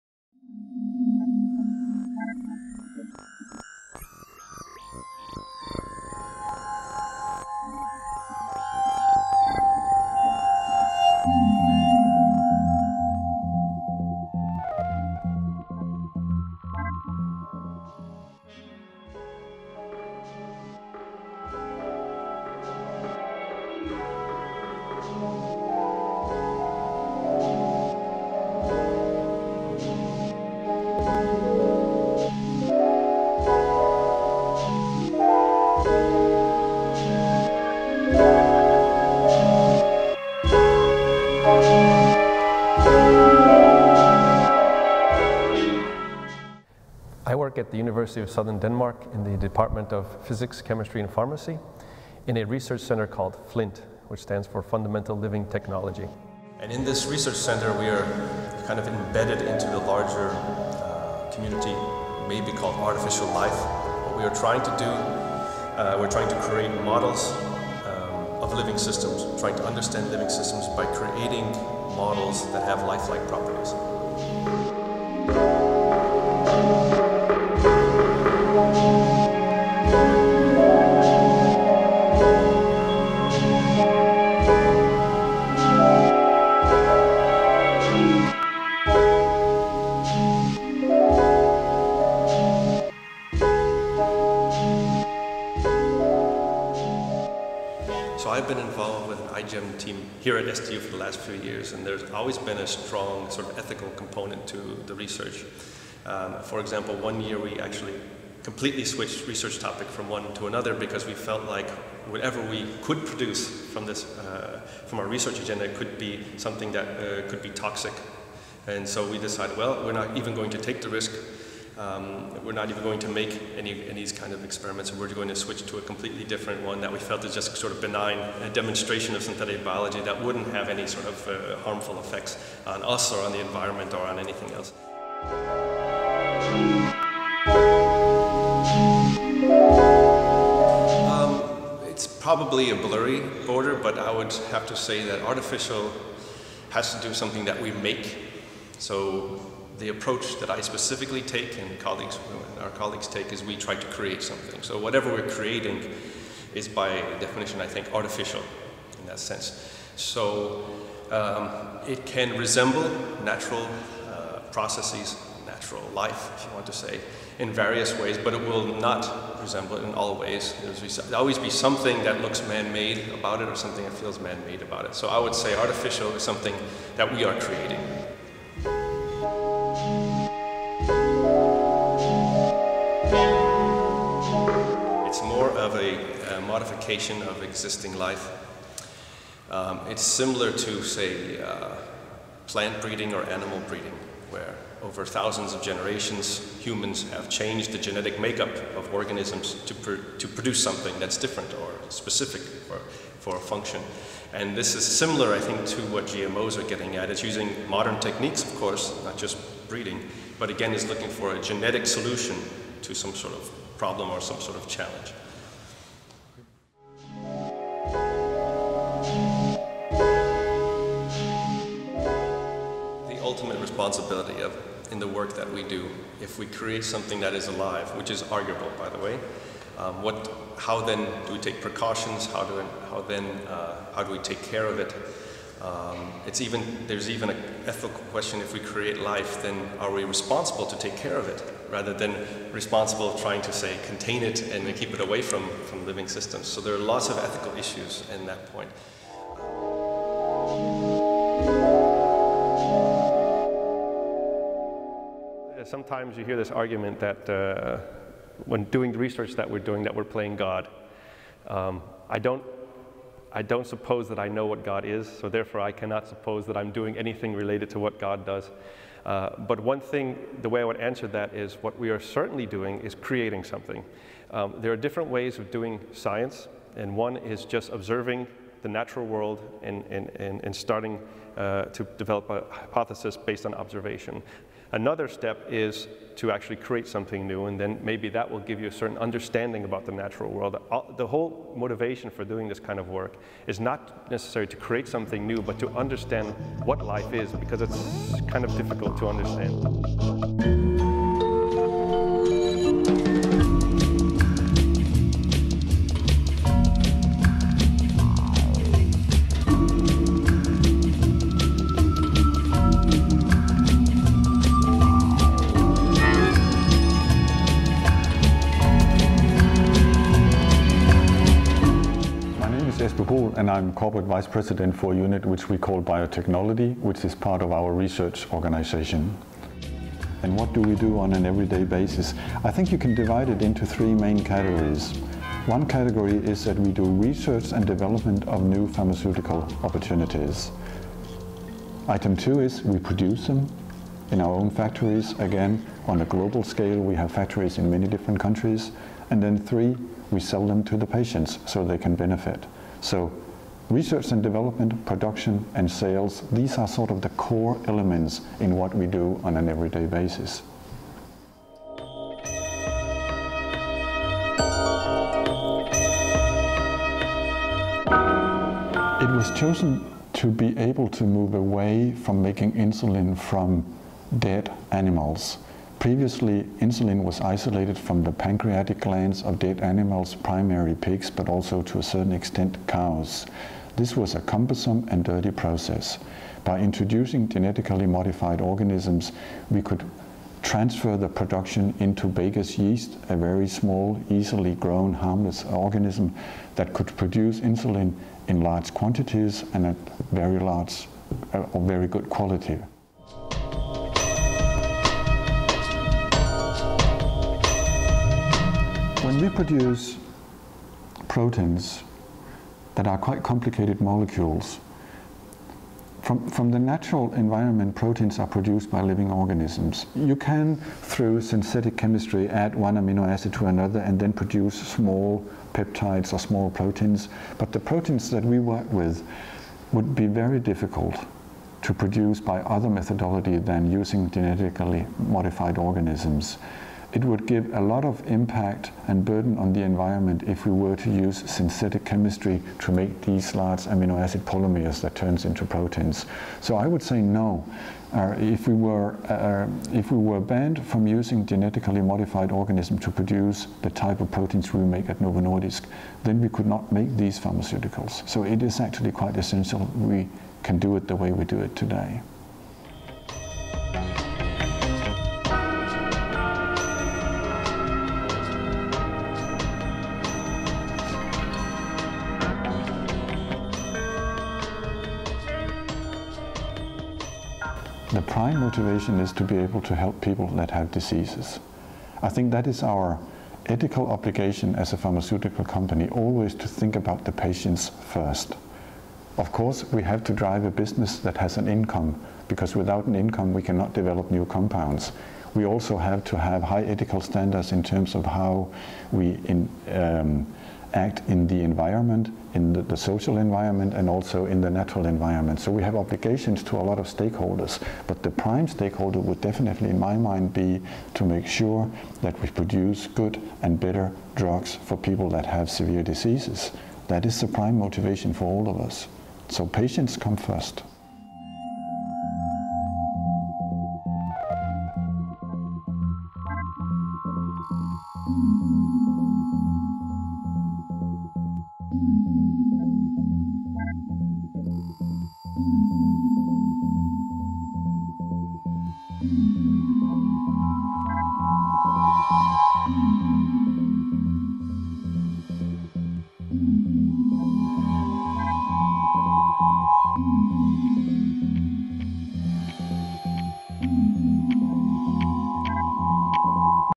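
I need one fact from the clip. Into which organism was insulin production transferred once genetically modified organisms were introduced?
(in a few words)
baker's yeast.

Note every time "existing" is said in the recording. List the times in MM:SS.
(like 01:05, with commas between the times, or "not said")
03:07.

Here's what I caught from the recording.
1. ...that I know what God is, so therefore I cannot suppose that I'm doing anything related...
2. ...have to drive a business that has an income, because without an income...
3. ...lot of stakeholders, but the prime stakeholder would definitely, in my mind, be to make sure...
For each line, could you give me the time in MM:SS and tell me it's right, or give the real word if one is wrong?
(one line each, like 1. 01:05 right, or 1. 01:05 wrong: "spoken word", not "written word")
1. 04:24 right
2. 08:09 right
3. 08:26 right.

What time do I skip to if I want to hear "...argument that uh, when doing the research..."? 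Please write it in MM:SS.
04:16.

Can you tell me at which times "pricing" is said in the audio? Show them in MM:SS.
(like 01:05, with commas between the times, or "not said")
not said.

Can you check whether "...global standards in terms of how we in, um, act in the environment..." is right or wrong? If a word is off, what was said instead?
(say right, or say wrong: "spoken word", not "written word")
wrong: "ethical", not "global".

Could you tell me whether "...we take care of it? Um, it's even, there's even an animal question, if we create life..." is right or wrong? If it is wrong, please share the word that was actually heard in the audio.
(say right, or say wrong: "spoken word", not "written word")
wrong: "ethical", not "animal".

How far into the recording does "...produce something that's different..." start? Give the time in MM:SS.
03:20.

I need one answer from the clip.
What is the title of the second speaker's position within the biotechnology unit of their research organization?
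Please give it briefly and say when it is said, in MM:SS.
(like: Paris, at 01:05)
Corporate Vice President, at 05:23.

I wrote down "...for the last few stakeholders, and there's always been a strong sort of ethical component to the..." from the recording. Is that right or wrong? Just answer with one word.
wrong.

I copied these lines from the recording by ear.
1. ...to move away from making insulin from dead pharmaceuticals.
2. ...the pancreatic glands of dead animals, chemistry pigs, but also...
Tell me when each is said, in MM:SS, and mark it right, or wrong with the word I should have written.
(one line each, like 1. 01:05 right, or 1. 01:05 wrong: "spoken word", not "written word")
1. 06:10 wrong: "animals", not "pharmaceuticals"
2. 06:18 wrong: "primary", not "chemistry".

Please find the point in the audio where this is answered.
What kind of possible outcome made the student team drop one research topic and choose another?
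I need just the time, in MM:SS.
01:57.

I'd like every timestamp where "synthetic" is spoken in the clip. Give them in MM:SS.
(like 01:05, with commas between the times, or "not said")
02:09, 07:01, 07:21.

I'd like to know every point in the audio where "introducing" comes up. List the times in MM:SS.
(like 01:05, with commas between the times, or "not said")
06:26.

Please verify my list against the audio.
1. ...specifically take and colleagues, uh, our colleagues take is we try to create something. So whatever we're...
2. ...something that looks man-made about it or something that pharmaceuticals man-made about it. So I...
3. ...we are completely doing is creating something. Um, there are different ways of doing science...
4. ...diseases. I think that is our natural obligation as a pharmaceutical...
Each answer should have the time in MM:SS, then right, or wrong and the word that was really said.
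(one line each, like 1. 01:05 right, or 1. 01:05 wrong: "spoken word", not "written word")
1. 02:30 right
2. 02:51 wrong: "feels", not "pharmaceuticals"
3. 04:31 wrong: "certainly", not "completely"
4. 08:00 wrong: "ethical", not "natural".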